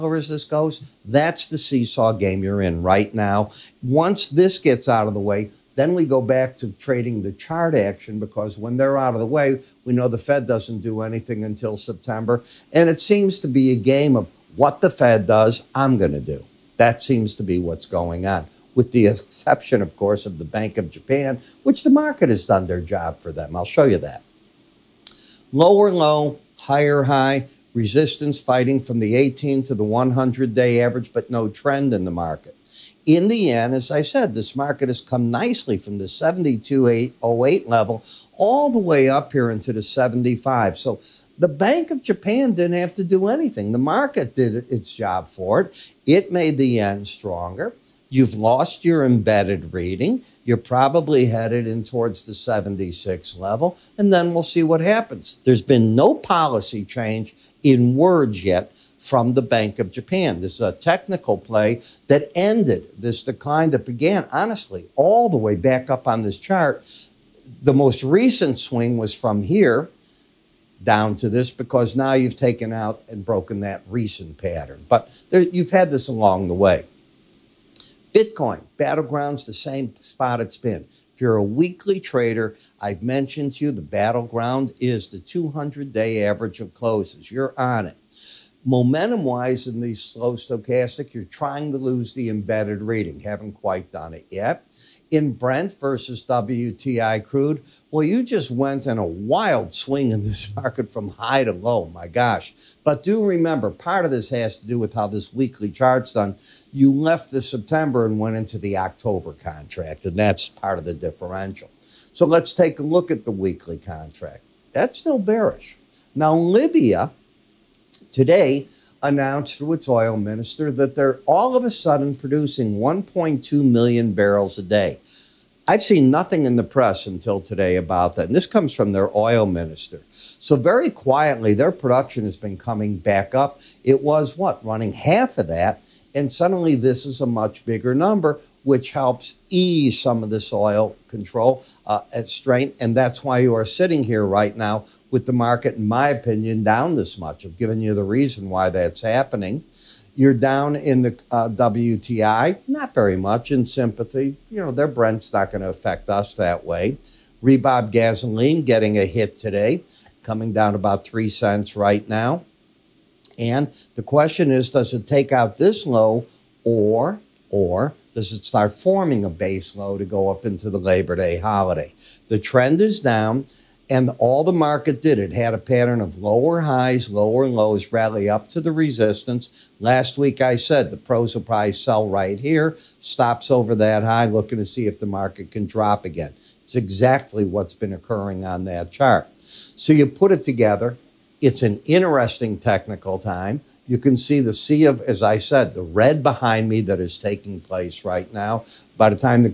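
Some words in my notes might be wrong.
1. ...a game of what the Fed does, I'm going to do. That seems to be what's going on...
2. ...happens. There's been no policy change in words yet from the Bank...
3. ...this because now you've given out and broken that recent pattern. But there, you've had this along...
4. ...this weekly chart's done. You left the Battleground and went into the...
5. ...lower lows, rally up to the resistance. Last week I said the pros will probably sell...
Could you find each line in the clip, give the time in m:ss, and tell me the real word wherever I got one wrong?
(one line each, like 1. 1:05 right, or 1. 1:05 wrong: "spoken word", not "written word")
1. 0:13 right
2. 0:54 right
3. 1:11 wrong: "taken", not "given"
4. 1:45 wrong: "September", not "Battleground"
5. 2:57 right.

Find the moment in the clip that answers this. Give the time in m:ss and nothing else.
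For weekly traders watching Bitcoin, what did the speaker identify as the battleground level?
1:25.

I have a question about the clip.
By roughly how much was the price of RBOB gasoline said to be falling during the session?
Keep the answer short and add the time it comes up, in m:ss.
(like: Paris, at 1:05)
3 cents, at 2:41.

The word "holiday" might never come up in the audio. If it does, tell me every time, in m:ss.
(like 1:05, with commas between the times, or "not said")
2:51.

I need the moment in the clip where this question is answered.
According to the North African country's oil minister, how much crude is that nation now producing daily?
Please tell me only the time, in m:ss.
2:02.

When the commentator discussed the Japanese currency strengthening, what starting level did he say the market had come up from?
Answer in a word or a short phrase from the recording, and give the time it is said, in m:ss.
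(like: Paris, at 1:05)
72.08, at 0:36.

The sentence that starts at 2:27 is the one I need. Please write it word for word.
I've given you the reason why that's happening.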